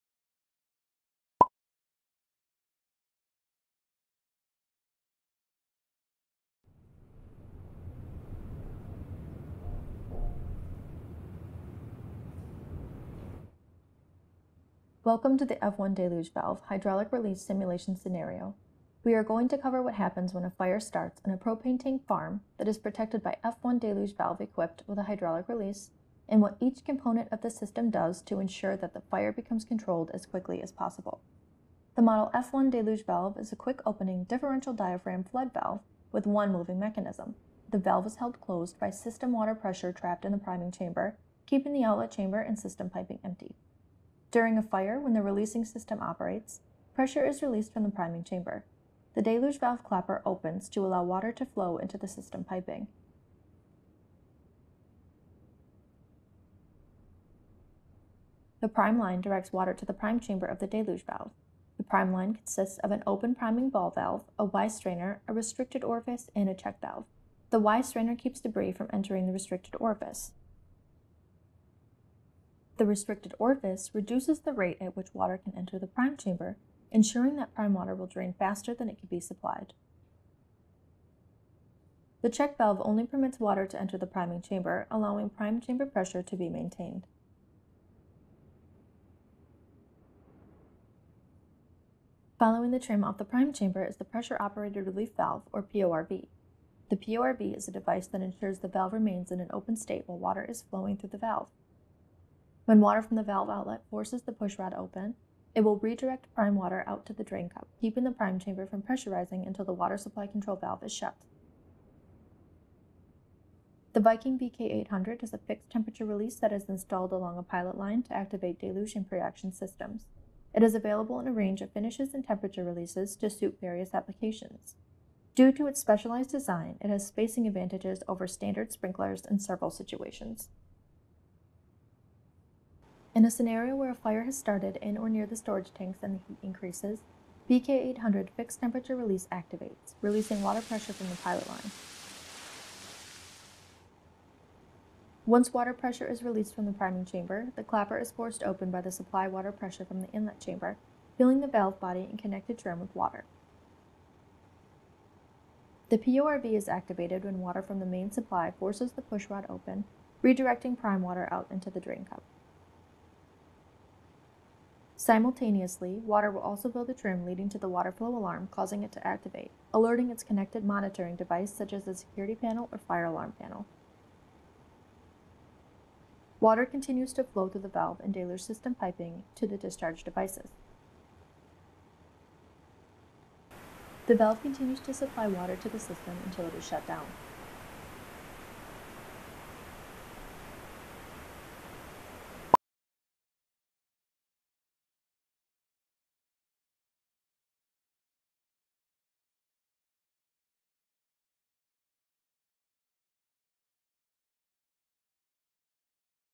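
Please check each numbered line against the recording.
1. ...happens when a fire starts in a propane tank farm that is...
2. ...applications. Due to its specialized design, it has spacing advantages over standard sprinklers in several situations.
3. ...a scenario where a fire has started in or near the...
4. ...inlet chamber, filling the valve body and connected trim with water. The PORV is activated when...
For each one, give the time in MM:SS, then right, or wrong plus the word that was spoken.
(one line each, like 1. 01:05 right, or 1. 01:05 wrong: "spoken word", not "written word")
1. 00:19 right
2. 02:03 right
3. 02:13 right
4. 02:30 right.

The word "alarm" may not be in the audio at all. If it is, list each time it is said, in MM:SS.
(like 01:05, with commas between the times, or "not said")
02:48, 02:53.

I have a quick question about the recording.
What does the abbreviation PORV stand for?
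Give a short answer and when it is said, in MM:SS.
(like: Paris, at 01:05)
Pressure Operated Relief Valve, at 01:34.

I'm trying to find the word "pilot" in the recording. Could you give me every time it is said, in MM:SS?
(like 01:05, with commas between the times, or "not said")
01:57, 02:21.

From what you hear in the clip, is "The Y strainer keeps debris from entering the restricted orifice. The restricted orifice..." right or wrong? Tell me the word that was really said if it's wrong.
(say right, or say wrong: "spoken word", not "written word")
right.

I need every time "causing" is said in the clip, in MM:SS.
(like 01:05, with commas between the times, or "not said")
02:48.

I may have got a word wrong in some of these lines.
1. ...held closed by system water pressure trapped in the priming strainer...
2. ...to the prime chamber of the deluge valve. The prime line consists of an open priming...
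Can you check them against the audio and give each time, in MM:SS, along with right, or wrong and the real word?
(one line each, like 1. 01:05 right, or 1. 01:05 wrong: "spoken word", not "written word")
1. 00:38 wrong: "chamber", not "strainer"
2. 00:59 right.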